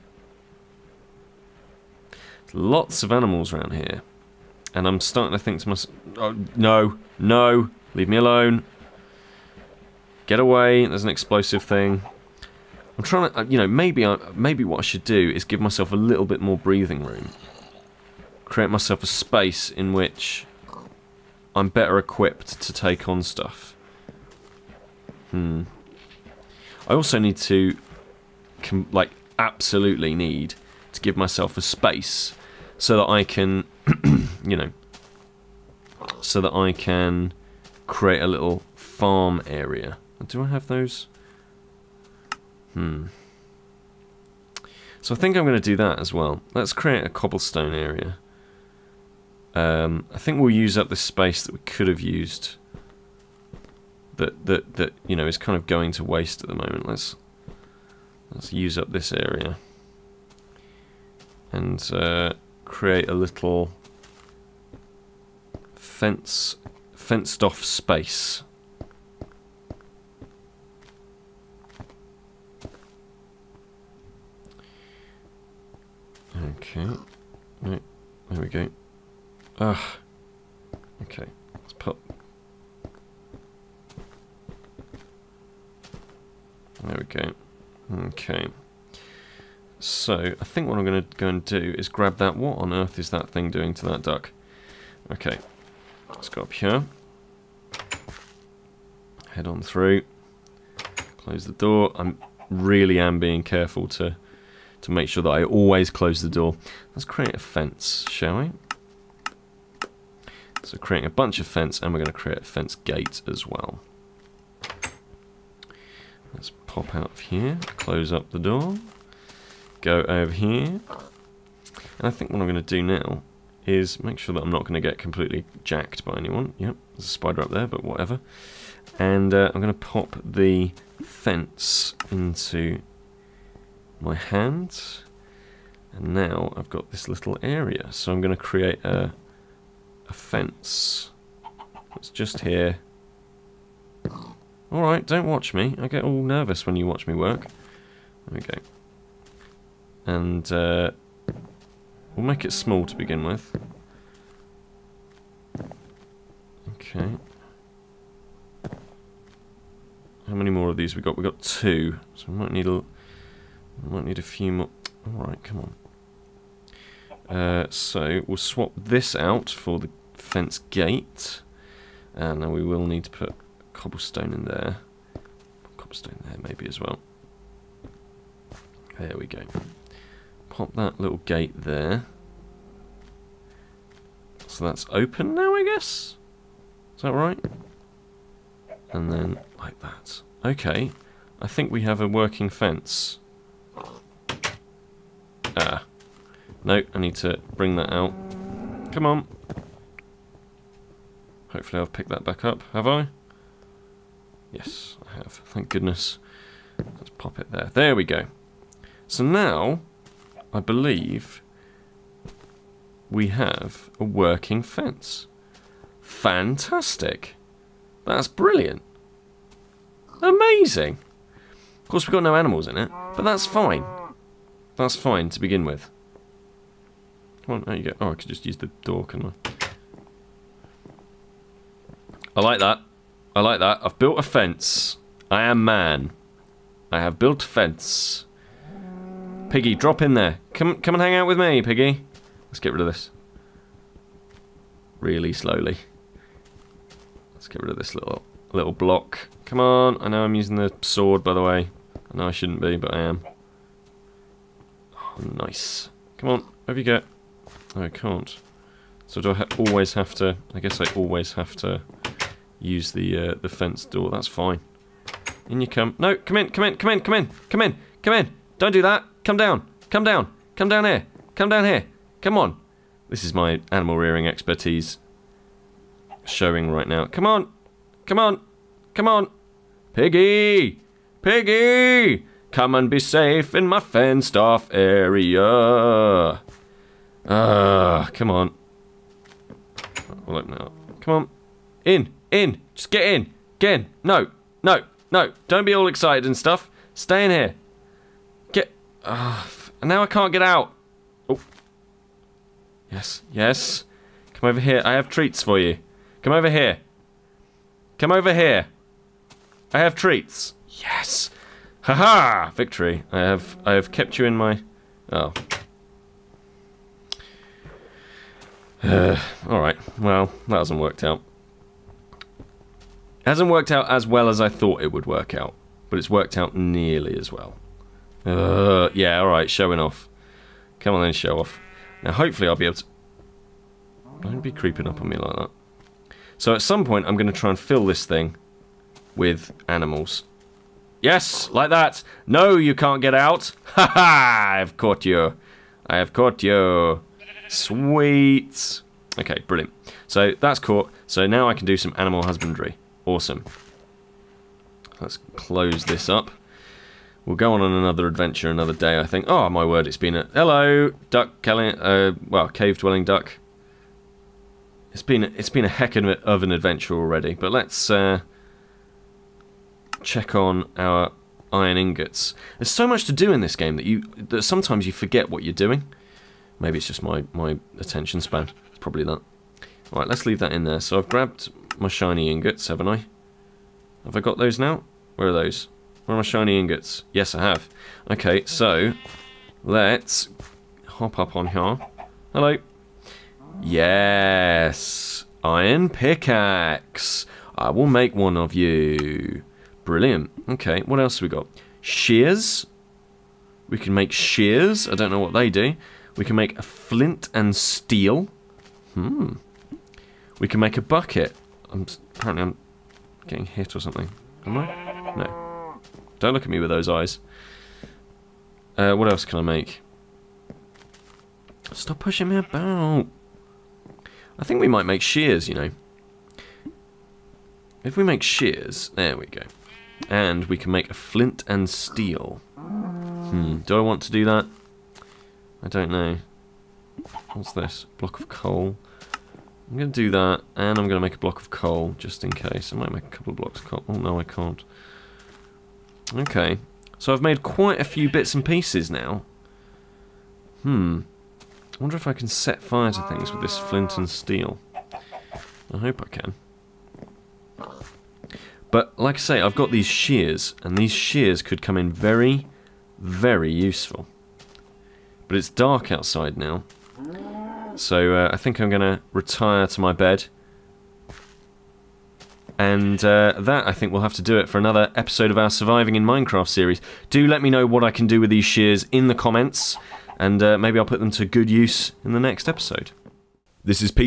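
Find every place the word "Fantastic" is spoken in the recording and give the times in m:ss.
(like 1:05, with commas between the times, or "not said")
3:36.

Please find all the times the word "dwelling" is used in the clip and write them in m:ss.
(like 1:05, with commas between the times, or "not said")
6:02.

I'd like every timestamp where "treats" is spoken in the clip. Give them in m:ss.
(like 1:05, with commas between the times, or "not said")
5:05, 5:09.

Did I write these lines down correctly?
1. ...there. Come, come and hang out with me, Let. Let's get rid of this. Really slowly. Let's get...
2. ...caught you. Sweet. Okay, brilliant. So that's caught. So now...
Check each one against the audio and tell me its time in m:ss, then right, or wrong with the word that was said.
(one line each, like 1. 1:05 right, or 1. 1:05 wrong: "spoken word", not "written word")
1. 4:00 wrong: "Piggy", not "Let"
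2. 5:46 right.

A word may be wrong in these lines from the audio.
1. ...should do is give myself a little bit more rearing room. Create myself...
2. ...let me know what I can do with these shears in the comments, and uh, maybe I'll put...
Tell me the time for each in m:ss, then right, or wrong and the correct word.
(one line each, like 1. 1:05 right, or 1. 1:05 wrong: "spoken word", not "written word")
1. 0:14 wrong: "breathing", not "rearing"
2. 7:57 right.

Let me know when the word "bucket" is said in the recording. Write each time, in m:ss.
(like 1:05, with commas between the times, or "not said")
6:50.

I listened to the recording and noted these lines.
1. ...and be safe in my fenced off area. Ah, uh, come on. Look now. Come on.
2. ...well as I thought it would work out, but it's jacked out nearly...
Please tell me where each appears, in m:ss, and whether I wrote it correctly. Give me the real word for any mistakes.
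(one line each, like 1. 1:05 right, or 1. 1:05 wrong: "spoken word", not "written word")
1. 4:42 right
2. 5:24 wrong: "worked", not "jacked".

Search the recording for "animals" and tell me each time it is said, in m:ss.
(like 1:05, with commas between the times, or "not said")
0:03, 3:42, 4:33, 5:39, 5:51.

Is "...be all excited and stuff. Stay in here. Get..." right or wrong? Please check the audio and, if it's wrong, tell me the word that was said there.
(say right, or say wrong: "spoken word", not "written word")
right.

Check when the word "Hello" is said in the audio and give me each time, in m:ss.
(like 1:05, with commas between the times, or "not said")
6:00, 6:32.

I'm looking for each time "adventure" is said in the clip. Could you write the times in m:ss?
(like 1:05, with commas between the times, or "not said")
5:58, 6:06.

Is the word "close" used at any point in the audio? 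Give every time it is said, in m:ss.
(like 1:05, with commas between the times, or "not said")
1:41, 1:45, 1:57, 5:55.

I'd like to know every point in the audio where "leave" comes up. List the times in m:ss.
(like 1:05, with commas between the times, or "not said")
0:07, 6:20.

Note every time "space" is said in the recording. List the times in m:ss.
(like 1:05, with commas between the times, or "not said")
0:19, 0:31, 0:50, 1:07.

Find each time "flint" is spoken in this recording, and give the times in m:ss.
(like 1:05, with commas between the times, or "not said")
6:46, 7:10, 7:33.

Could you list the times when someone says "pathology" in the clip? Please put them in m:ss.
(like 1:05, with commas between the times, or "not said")
not said.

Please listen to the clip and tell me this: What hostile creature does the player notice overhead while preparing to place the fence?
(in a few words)
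Spider.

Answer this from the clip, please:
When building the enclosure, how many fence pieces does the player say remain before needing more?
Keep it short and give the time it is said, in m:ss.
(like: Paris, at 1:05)
2, at 2:41.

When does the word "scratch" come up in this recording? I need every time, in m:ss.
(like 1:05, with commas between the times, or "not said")
not said.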